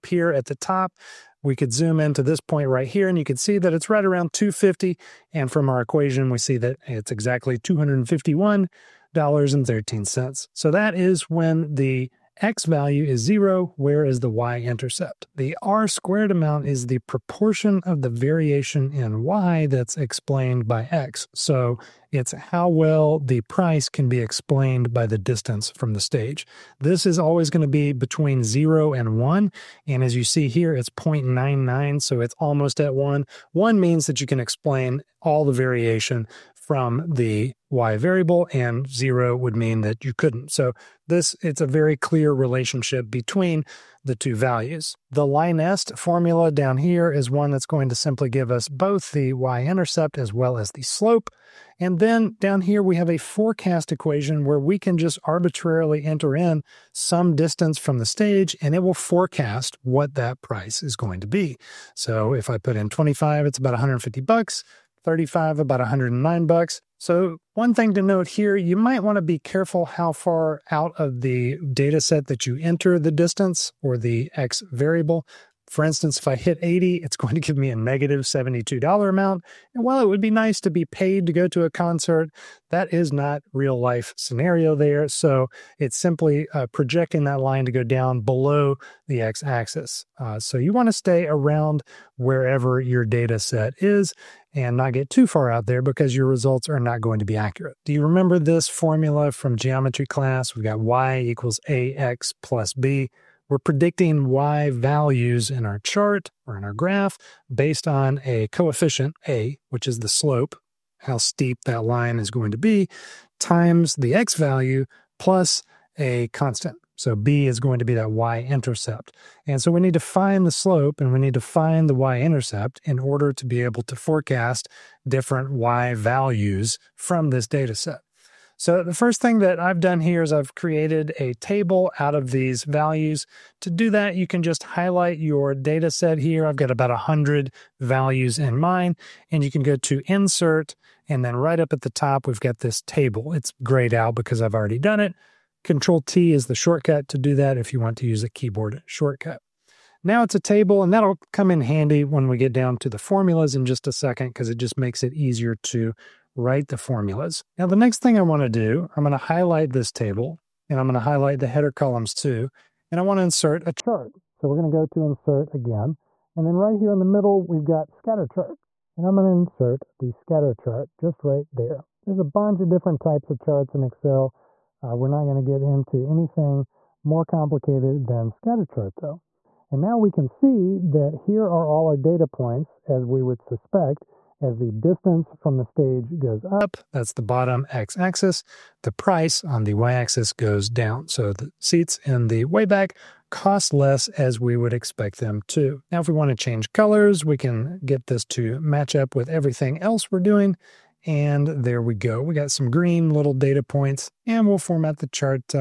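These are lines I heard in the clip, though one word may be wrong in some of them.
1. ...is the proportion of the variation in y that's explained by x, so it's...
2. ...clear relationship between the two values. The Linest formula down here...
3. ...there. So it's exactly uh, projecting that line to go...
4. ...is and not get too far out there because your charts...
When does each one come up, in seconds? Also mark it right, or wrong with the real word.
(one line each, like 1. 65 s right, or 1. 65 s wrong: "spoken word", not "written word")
1. 16 s right
2. 41 s right
3. 84 s wrong: "simply", not "exactly"
4. 93 s wrong: "results", not "charts".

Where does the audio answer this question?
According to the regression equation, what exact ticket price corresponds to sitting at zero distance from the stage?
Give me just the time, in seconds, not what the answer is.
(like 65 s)
7 s.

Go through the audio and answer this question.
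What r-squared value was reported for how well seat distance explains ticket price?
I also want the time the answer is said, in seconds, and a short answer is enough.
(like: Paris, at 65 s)
0.99, at 30 s.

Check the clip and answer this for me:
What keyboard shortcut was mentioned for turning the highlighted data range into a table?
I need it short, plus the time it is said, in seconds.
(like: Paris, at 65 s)
Control T, at 145 s.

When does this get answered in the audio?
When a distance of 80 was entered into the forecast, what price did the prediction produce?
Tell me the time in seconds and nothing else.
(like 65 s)
77 s.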